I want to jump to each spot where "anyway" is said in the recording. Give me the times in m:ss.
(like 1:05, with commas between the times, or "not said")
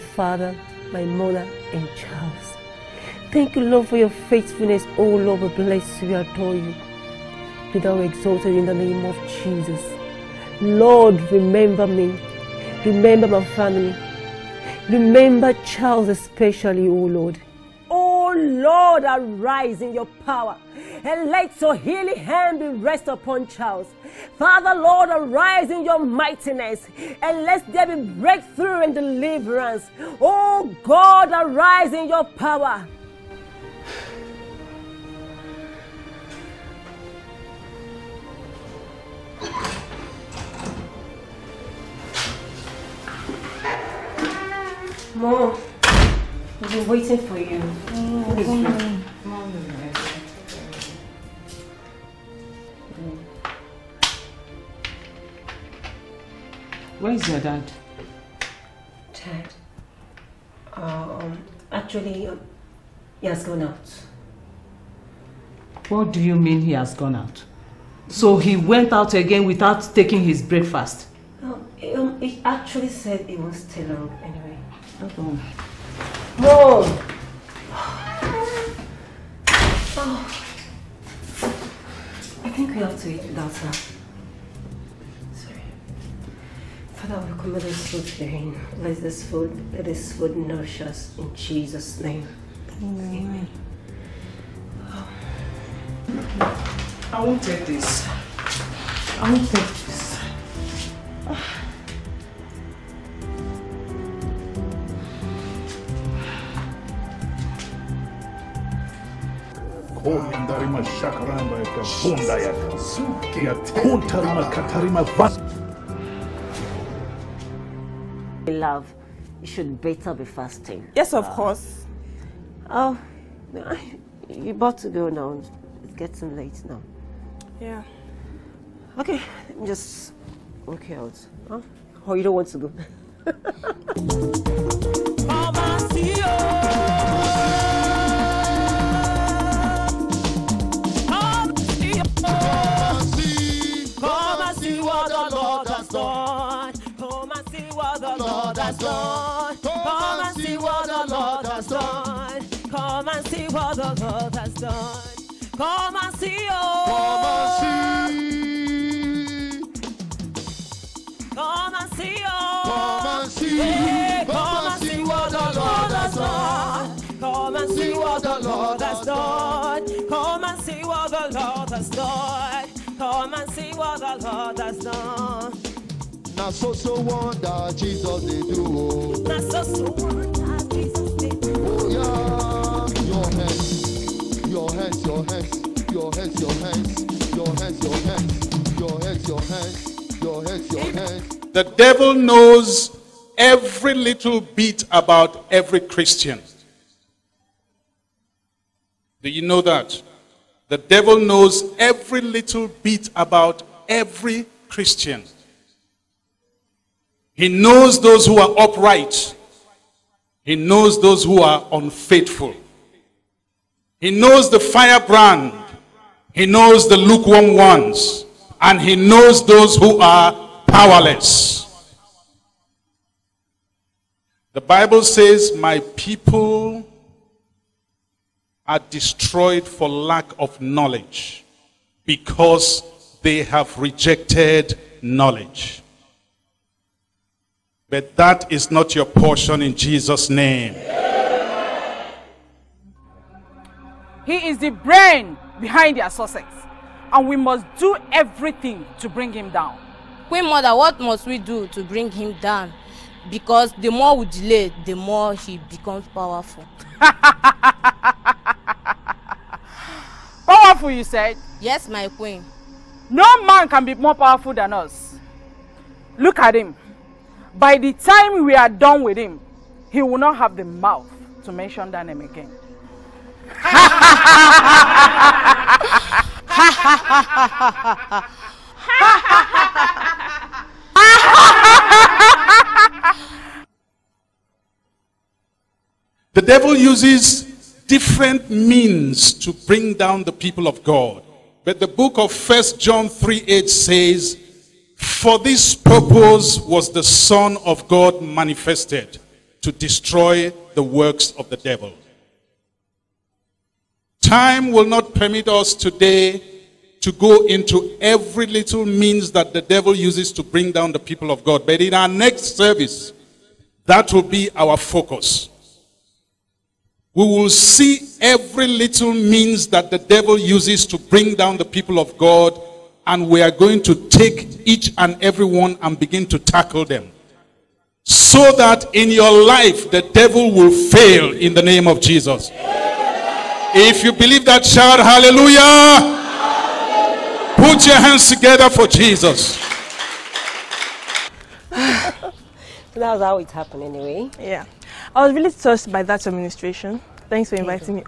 1:14, 5:43.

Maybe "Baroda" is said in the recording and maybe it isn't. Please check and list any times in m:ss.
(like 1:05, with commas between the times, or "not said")
not said.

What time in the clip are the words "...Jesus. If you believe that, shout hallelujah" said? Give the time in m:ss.
5:32.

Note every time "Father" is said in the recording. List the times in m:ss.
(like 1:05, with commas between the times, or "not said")
0:24, 1:26.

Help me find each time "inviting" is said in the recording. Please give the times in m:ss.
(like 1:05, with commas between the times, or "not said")
5:47.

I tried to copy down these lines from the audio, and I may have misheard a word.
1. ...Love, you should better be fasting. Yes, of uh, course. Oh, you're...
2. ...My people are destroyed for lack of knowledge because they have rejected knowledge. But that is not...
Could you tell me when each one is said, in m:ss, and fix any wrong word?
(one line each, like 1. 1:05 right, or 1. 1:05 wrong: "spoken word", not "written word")
1. 1:58 right
2. 3:45 right.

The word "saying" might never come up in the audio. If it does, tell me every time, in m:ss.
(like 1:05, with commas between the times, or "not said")
not said.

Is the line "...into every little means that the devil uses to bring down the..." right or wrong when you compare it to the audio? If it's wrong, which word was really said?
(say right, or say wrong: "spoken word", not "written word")
right.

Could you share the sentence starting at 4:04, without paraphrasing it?
He is the brain behind their success.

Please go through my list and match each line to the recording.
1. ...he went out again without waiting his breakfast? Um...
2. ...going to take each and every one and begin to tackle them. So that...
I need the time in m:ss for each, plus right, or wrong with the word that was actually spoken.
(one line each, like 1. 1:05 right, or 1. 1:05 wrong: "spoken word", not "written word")
1. 1:08 wrong: "taking", not "waiting"
2. 5:23 right.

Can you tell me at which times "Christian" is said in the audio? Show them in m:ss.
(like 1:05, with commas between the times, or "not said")
3:15, 3:24.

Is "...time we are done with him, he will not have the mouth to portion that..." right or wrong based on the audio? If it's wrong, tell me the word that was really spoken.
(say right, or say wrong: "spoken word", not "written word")
wrong: "mention", not "portion".